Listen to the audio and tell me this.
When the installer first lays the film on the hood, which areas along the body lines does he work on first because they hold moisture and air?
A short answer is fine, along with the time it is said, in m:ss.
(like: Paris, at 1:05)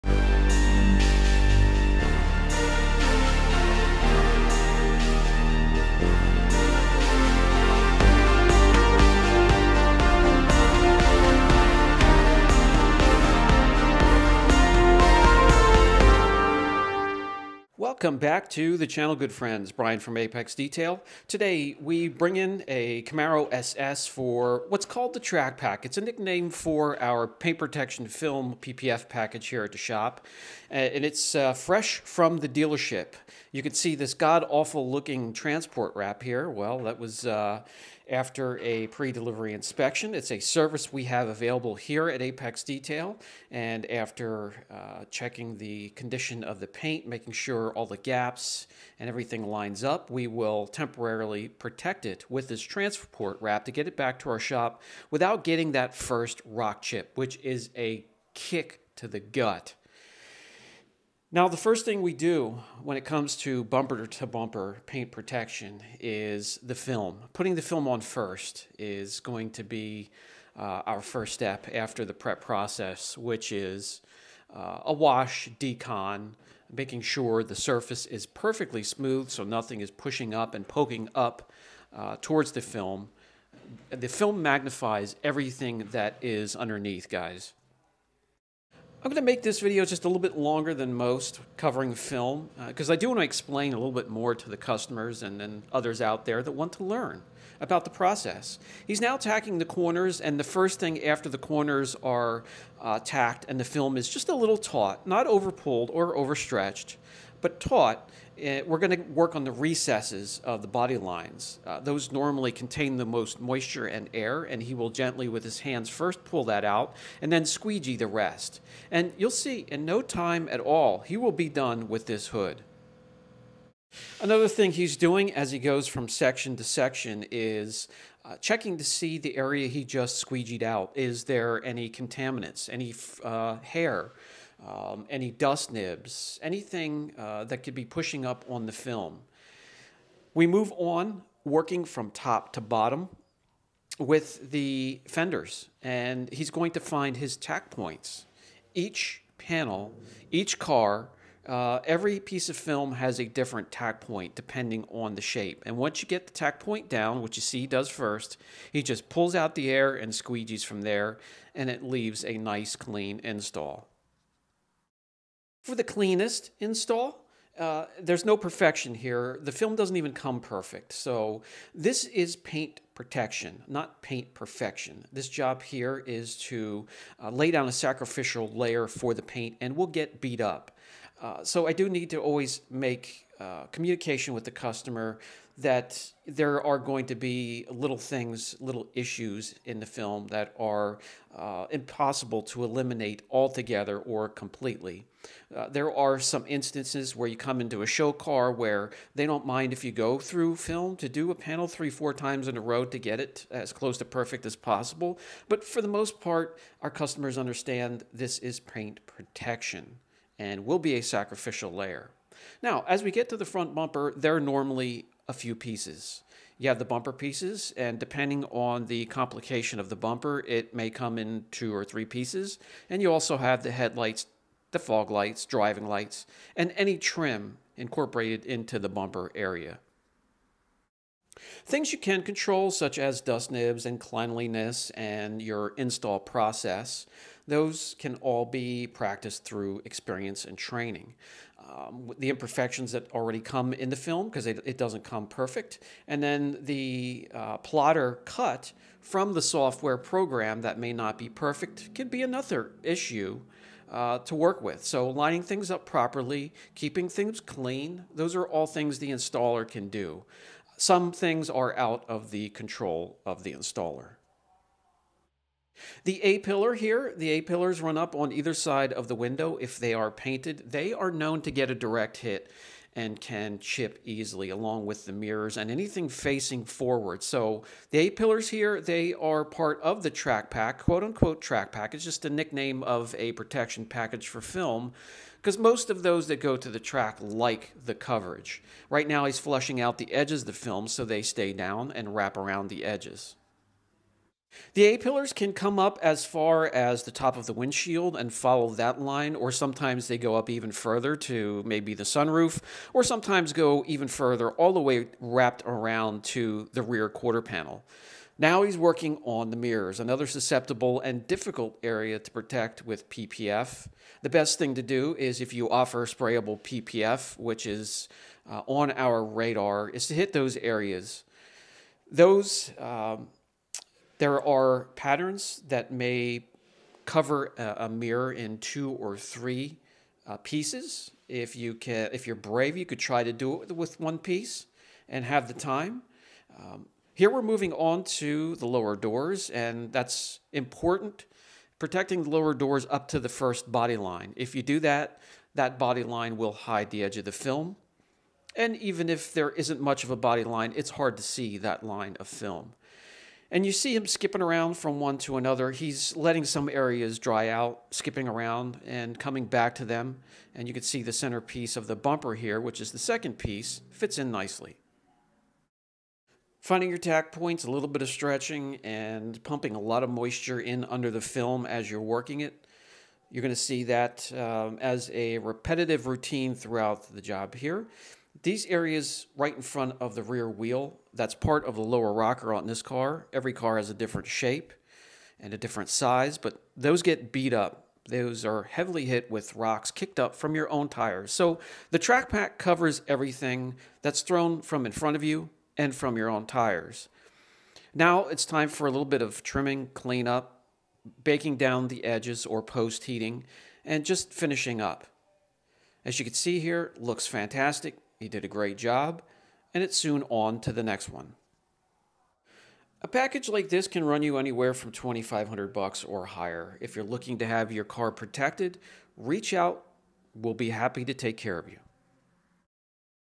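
recesses, at 1:49.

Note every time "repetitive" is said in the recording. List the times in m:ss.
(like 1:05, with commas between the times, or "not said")
6:15.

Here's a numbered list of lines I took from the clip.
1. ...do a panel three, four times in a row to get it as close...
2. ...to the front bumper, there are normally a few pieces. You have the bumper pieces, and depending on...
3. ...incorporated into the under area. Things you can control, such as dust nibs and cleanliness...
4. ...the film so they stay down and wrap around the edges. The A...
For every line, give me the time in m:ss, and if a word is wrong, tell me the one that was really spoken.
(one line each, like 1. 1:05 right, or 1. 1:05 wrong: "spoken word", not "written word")
1. 3:21 right
2. 3:33 right
3. 3:47 wrong: "bumper", not "under"
4. 4:50 right.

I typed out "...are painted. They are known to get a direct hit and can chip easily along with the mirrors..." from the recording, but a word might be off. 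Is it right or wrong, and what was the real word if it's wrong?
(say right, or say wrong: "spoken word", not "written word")
right.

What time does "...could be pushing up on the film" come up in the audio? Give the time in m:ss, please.
2:17.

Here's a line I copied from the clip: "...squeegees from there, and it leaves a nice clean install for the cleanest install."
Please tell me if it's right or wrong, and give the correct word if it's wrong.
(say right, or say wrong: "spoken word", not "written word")
right.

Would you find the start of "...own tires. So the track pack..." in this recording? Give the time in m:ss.
6:30.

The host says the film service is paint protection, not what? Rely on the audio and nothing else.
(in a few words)
paint perfection.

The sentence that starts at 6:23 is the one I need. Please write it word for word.
Every car has a different shape and a different size, but those get beat up.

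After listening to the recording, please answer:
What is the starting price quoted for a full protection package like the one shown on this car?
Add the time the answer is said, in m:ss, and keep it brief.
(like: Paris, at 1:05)
$2500, at 6:54.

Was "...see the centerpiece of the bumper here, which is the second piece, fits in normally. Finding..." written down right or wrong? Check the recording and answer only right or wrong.
wrong.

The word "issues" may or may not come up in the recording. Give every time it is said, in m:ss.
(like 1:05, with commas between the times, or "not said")
3:08, 4:12.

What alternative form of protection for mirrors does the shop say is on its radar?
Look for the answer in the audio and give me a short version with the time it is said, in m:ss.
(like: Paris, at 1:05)
sprayable PPF, at 5:16.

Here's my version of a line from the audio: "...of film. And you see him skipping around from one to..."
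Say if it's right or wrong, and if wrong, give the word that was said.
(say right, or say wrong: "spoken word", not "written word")
right.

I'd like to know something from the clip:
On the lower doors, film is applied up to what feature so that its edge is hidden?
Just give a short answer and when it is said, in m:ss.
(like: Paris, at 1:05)
first body line, at 5:43.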